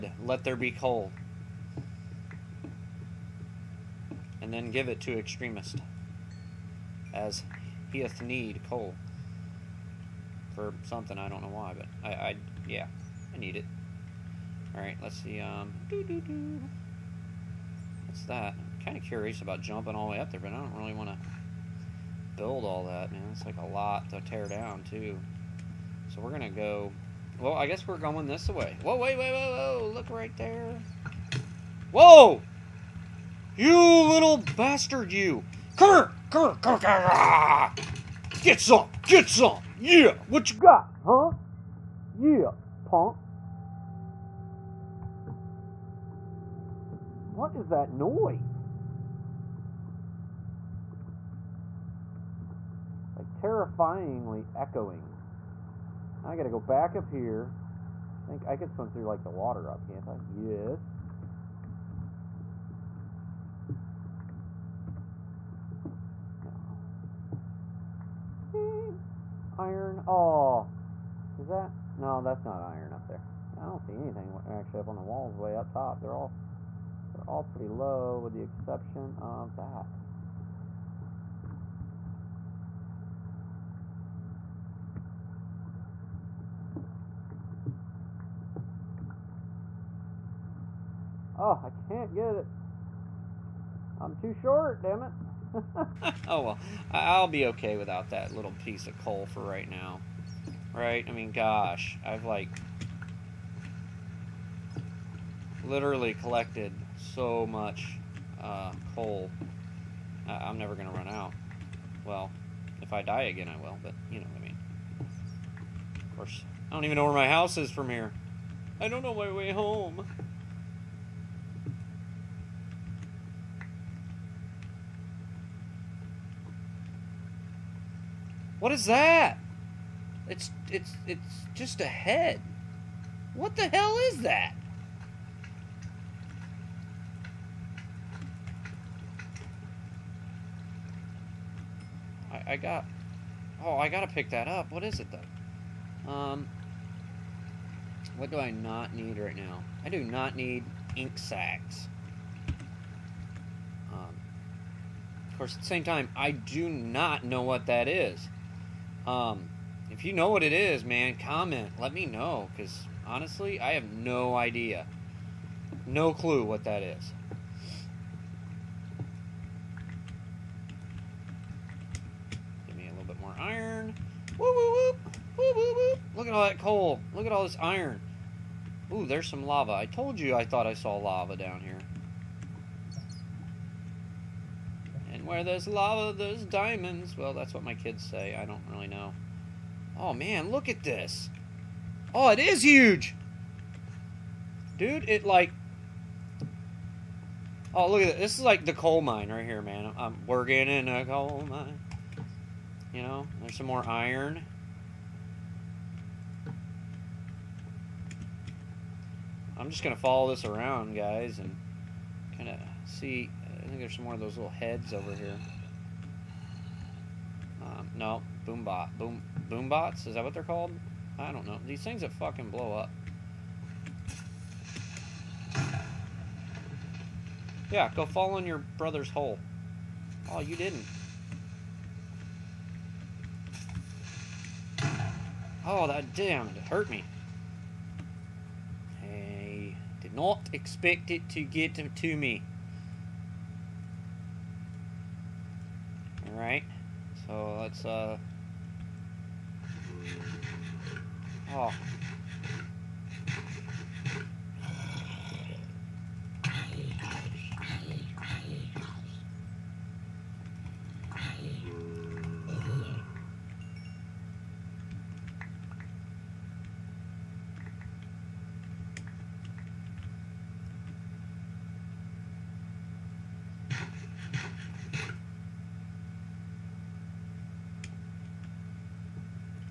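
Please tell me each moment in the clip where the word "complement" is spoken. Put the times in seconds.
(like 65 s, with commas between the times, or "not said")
not said.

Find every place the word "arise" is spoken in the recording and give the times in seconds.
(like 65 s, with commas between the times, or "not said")
not said.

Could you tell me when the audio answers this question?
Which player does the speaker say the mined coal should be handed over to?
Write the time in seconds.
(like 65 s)
5 s.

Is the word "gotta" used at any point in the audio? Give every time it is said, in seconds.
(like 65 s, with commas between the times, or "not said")
56 s, 143 s.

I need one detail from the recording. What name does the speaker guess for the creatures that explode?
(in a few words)
Boombots.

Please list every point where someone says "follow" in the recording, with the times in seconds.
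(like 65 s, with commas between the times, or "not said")
209 s.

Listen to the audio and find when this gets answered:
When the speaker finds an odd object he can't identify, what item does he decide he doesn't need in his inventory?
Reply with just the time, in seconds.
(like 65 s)
150 s.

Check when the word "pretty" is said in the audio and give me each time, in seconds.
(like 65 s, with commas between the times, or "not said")
77 s.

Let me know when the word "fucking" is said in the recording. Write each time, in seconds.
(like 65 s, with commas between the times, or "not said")
222 s.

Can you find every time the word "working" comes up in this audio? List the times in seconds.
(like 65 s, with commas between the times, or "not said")
200 s.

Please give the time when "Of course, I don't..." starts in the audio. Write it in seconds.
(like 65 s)
116 s.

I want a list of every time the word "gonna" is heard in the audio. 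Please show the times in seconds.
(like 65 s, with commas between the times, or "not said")
26 s, 110 s.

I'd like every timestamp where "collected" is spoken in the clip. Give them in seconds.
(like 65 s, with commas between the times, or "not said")
106 s.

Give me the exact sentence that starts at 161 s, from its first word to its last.
Let me know, because honestly, I have no idea.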